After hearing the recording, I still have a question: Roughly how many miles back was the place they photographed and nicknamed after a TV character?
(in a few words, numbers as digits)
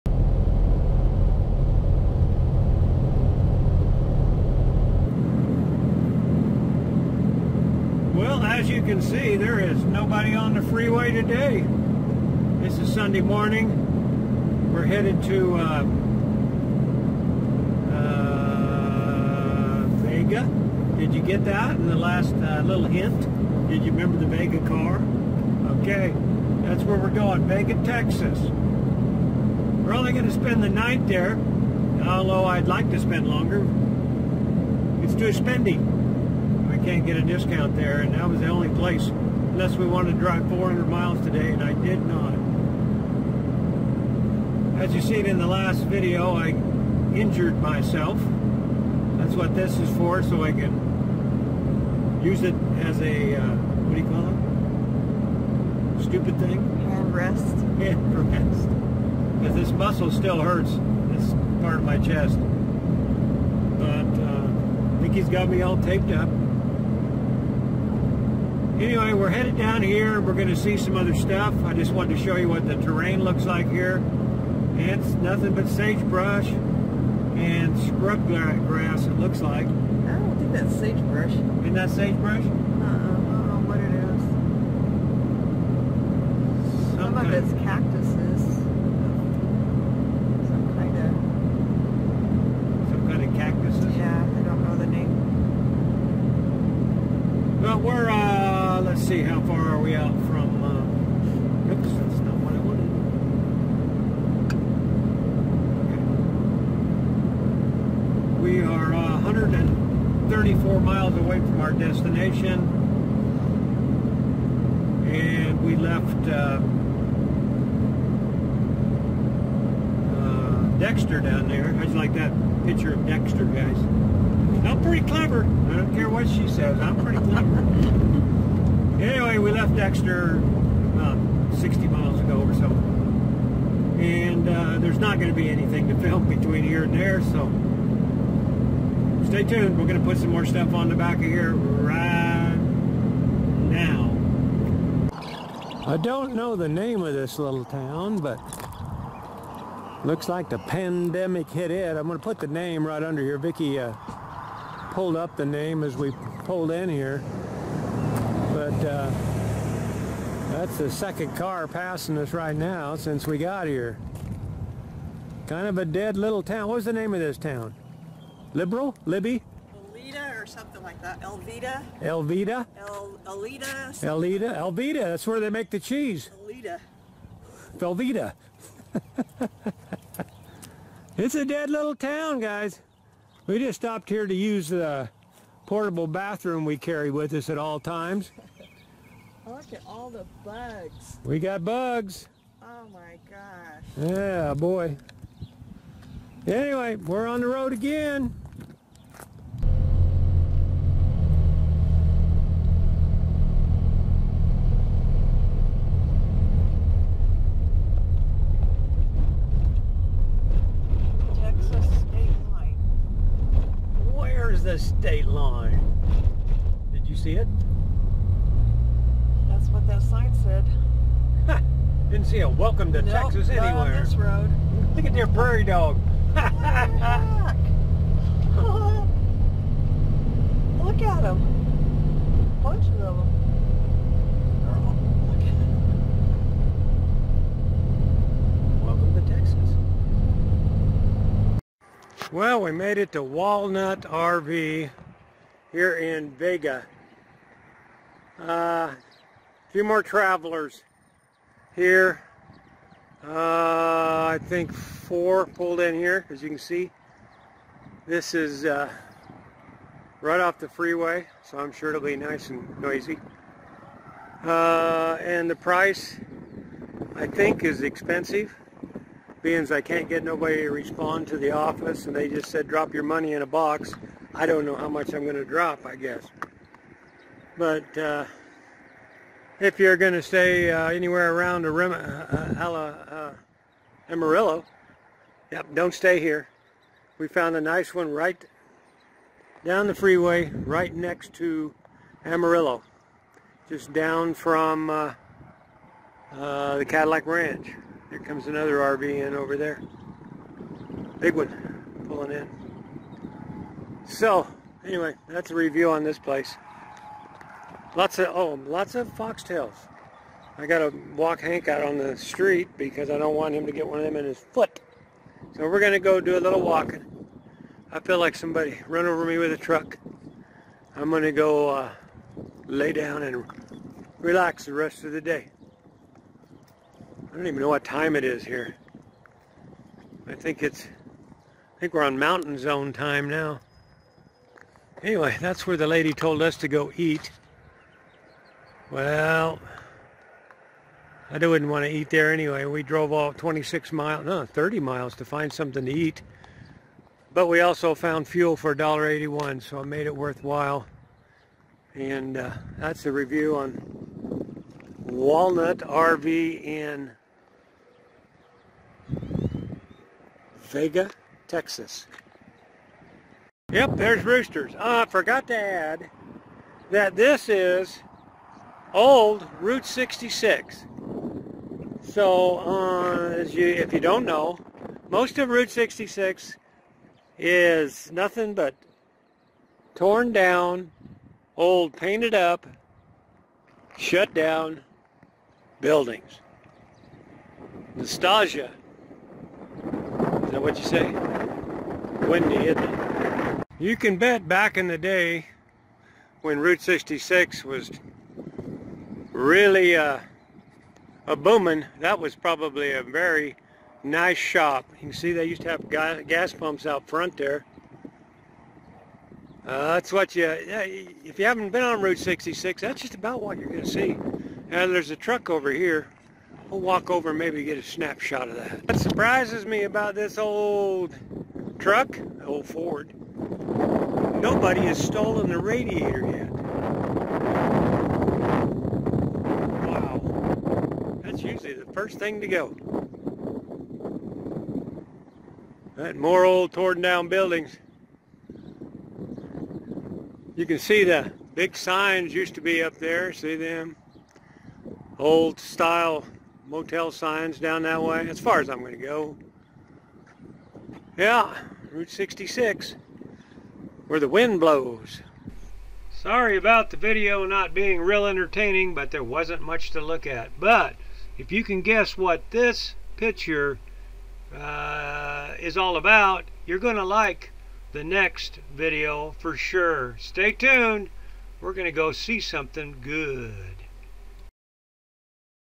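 60.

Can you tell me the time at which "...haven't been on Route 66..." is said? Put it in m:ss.
6:51.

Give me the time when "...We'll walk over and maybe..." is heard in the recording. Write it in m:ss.
6:56.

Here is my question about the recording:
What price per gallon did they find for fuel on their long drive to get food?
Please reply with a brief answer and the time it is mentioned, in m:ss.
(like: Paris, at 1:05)
$1.81, at 5:48.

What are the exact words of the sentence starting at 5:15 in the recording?
So we're going to go do a little walking.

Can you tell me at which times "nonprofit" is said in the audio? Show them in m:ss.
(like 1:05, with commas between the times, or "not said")
not said.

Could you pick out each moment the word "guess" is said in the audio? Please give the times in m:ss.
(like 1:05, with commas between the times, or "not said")
4:35, 7:41.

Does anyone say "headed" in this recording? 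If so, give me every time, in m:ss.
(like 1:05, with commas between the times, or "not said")
0:14, 1:09.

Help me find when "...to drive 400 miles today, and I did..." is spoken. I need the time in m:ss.
0:40.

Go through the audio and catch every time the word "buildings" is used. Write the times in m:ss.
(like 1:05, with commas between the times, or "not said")
6:25, 7:17.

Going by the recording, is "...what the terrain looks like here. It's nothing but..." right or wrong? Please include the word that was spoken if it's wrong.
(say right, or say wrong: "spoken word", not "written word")
right.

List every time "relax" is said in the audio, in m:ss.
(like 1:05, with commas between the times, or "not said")
5:24.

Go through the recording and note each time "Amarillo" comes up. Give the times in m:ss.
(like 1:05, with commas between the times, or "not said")
4:44, 4:52.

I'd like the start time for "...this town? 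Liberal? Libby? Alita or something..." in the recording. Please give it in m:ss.
2:47.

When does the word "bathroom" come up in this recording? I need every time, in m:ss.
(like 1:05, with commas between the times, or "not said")
3:06.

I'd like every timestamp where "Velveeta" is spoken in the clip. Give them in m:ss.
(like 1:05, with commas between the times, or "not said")
2:57.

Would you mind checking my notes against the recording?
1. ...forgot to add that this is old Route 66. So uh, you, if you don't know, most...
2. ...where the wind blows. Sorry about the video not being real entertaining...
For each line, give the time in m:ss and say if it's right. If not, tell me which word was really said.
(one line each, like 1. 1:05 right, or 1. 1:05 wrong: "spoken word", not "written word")
1. 6:05 right
2. 7:34 right.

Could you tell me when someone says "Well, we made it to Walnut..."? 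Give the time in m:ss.
4:02.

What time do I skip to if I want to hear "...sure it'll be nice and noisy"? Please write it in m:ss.
4:21.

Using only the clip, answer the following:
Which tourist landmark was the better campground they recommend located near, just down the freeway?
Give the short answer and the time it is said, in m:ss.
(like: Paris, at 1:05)
Cadillac Ranch, at 4:56.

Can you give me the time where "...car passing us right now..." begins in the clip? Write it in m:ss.
2:41.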